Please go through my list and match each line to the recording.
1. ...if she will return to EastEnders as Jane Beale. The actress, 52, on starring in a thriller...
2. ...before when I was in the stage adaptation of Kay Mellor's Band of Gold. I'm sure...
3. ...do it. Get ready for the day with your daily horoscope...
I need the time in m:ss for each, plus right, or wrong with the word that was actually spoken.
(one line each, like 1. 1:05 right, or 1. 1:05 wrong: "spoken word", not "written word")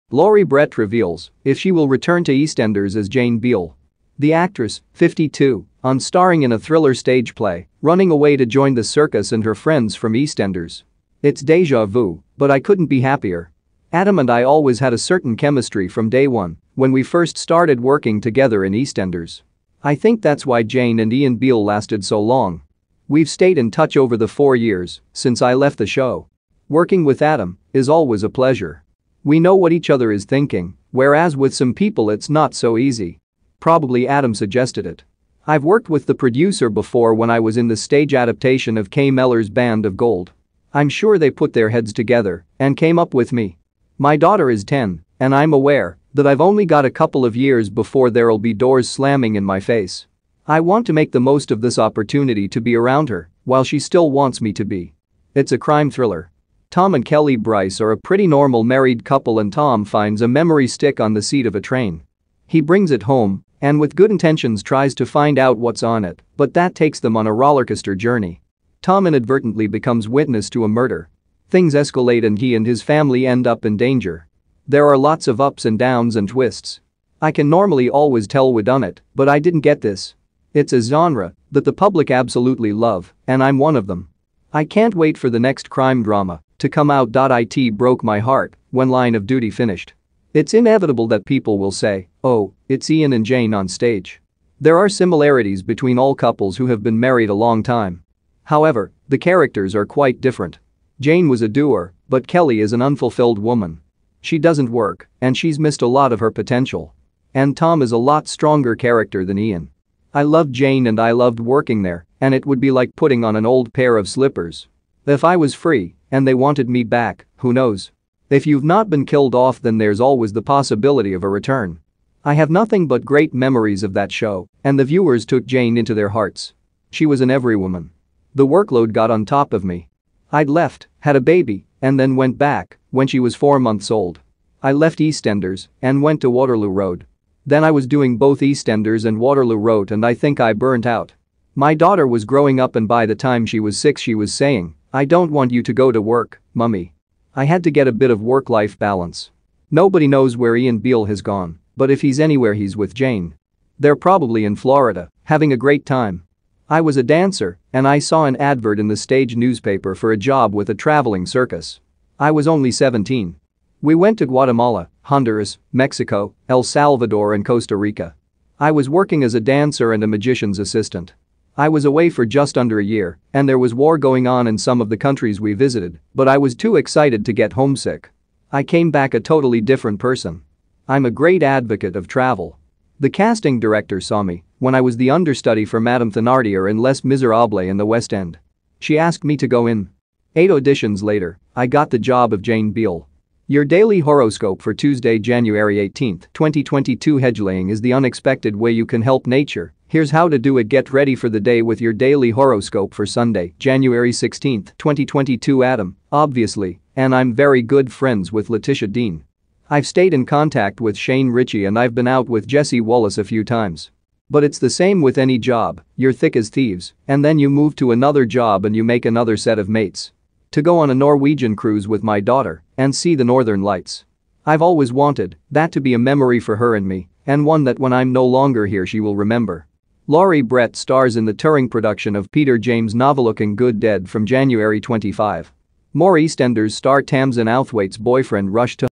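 1. 0:01 right
2. 0:36 right
3. 3:20 right.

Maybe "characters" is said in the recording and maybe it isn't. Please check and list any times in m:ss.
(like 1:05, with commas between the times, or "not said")
1:39, 1:48.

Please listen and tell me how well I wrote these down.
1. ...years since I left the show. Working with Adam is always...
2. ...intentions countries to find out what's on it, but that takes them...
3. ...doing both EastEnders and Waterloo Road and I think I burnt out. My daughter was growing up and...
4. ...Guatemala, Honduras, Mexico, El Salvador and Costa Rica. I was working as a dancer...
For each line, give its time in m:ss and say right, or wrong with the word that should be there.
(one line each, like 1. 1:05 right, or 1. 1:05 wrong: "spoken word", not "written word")
1. 0:24 right
2. 1:04 wrong: "tries", not "countries"
3. 2:17 right
4. 2:44 right.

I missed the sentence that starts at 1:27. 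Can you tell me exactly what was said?
It broke my heart when Line of Duty finished.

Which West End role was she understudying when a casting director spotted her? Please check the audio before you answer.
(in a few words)
Madame Thenardier.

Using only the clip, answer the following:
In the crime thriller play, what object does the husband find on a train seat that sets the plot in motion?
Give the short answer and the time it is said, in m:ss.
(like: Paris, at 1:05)
Memory stick, at 1:00.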